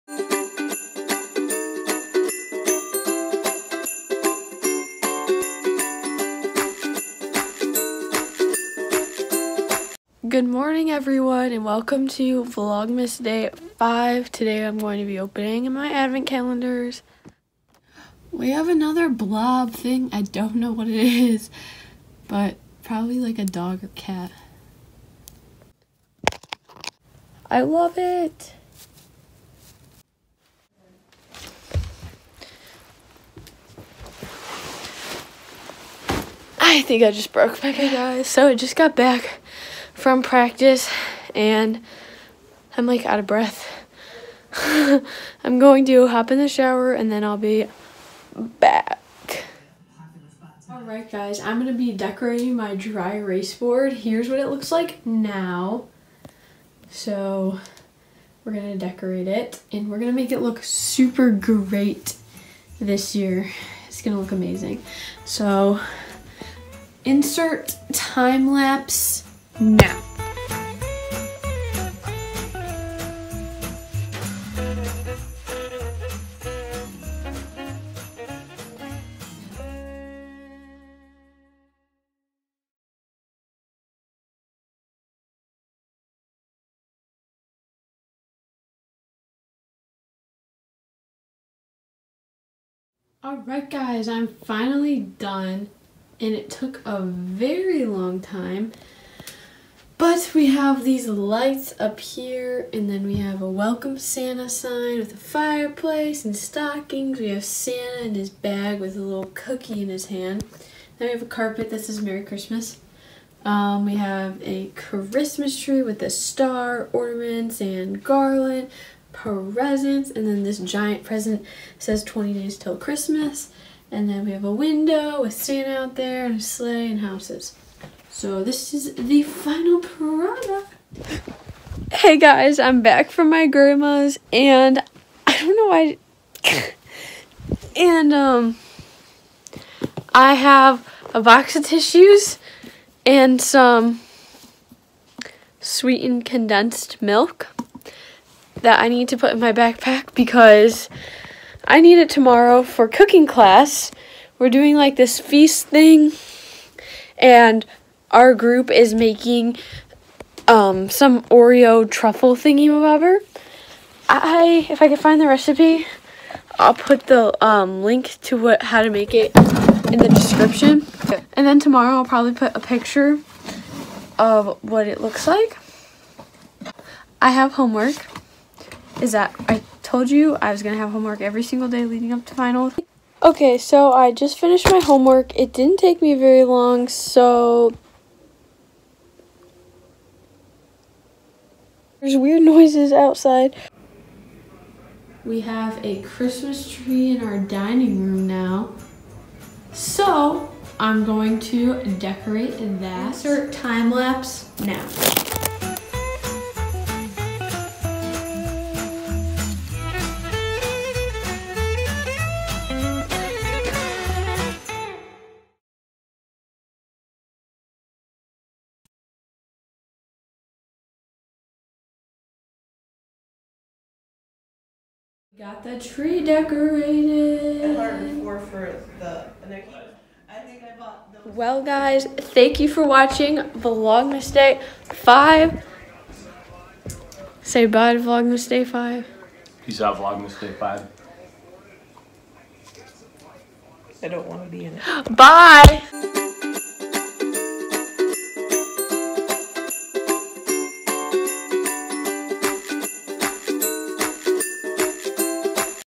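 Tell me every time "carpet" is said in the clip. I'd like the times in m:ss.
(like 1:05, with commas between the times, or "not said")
1:51.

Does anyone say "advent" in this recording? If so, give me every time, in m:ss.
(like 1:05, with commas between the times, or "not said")
0:15.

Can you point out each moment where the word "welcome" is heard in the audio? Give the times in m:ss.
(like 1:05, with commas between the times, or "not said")
0:11, 1:43.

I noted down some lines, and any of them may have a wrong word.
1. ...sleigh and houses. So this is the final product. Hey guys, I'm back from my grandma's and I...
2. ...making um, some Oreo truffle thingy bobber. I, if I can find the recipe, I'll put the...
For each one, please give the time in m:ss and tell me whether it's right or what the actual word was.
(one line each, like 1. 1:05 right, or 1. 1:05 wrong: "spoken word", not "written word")
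1. 2:06 right
2. 2:38 right.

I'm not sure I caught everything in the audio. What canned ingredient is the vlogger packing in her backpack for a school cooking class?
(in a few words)
Sweetened condensed milk.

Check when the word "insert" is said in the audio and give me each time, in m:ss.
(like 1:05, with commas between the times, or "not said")
1:07, 3:23.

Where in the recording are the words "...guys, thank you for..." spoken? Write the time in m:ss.
3:51.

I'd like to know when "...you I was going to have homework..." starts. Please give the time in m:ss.
3:00.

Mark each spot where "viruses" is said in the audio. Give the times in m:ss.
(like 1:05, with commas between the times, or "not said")
not said.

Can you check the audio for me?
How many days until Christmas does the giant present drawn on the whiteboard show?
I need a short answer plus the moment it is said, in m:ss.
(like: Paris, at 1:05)
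20, at 2:02.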